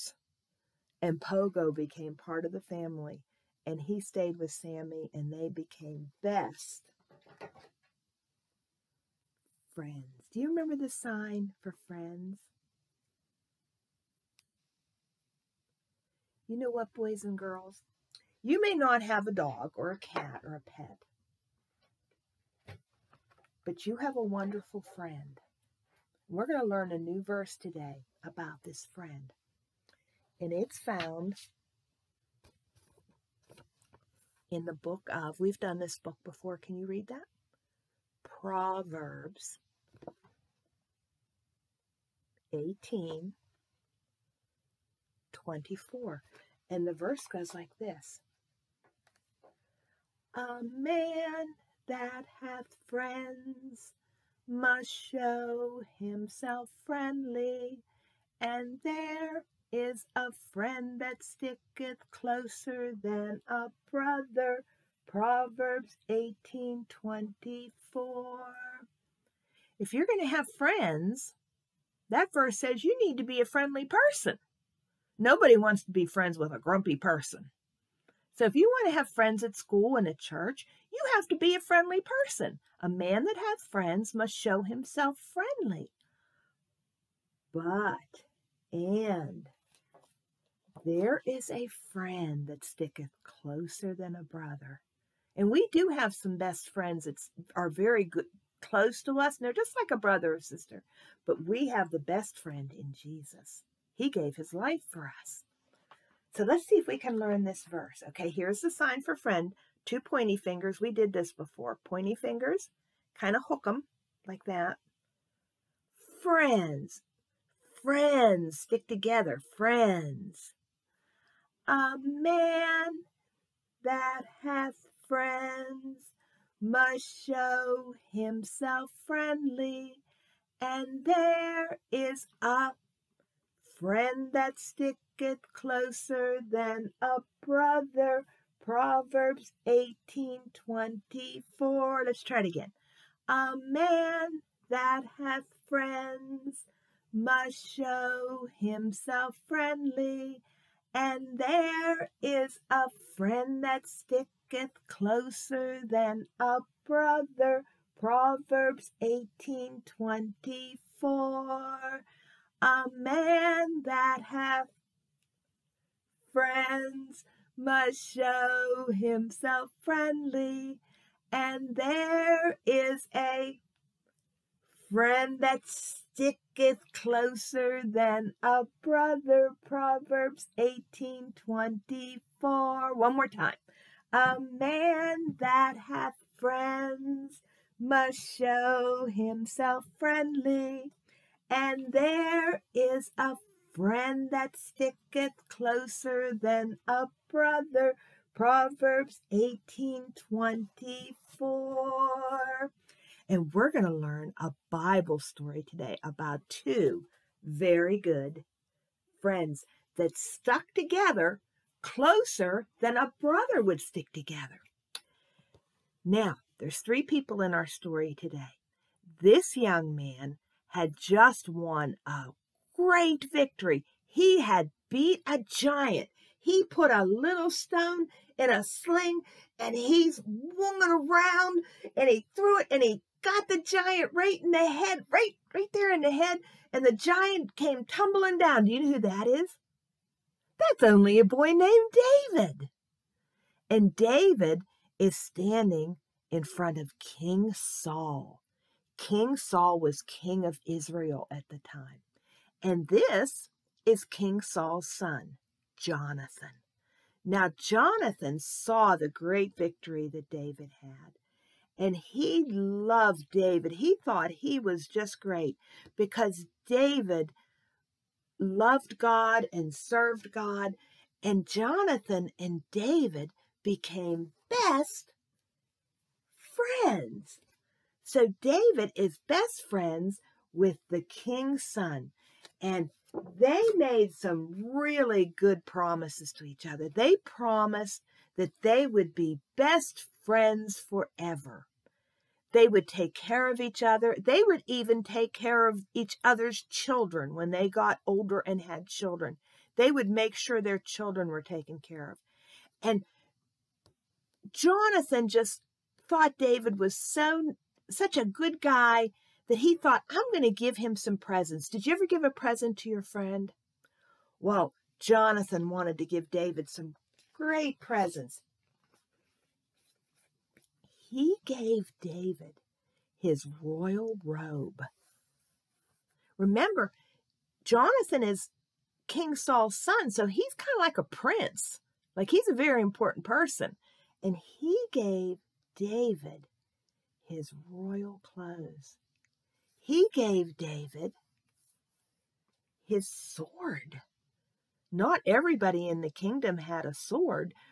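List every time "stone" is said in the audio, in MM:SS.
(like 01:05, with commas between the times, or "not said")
03:47.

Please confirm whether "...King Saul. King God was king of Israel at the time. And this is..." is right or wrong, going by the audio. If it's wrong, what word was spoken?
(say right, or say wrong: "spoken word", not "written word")
wrong: "Saul", not "God".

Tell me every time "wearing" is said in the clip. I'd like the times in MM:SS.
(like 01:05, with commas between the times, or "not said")
not said.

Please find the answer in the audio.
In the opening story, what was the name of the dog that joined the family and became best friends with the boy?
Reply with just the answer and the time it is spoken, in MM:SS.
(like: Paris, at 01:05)
Pogo, at 00:01.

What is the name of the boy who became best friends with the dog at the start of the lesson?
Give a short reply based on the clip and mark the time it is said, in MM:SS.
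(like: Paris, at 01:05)
Sammy, at 00:04.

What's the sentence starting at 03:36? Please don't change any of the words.
Now, there's three people in our story today.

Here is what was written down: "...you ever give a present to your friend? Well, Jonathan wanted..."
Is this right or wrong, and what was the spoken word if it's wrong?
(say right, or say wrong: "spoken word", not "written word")
right.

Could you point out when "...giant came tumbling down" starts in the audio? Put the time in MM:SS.
03:56.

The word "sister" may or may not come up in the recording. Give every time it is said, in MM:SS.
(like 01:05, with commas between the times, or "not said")
01:40.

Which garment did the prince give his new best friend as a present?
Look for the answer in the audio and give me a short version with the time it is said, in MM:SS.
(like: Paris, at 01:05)
royal robe, at 05:23.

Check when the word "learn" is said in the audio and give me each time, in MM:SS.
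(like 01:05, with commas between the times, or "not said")
00:26, 01:47, 03:23.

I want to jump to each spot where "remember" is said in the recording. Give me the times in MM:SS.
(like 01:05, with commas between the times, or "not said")
00:10, 05:26.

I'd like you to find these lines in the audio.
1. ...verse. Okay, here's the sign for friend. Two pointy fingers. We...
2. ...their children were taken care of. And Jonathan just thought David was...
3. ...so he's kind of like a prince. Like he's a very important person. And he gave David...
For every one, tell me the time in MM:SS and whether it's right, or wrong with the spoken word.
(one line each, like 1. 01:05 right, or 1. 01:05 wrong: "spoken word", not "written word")
1. 01:47 right
2. 05:00 right
3. 05:30 right.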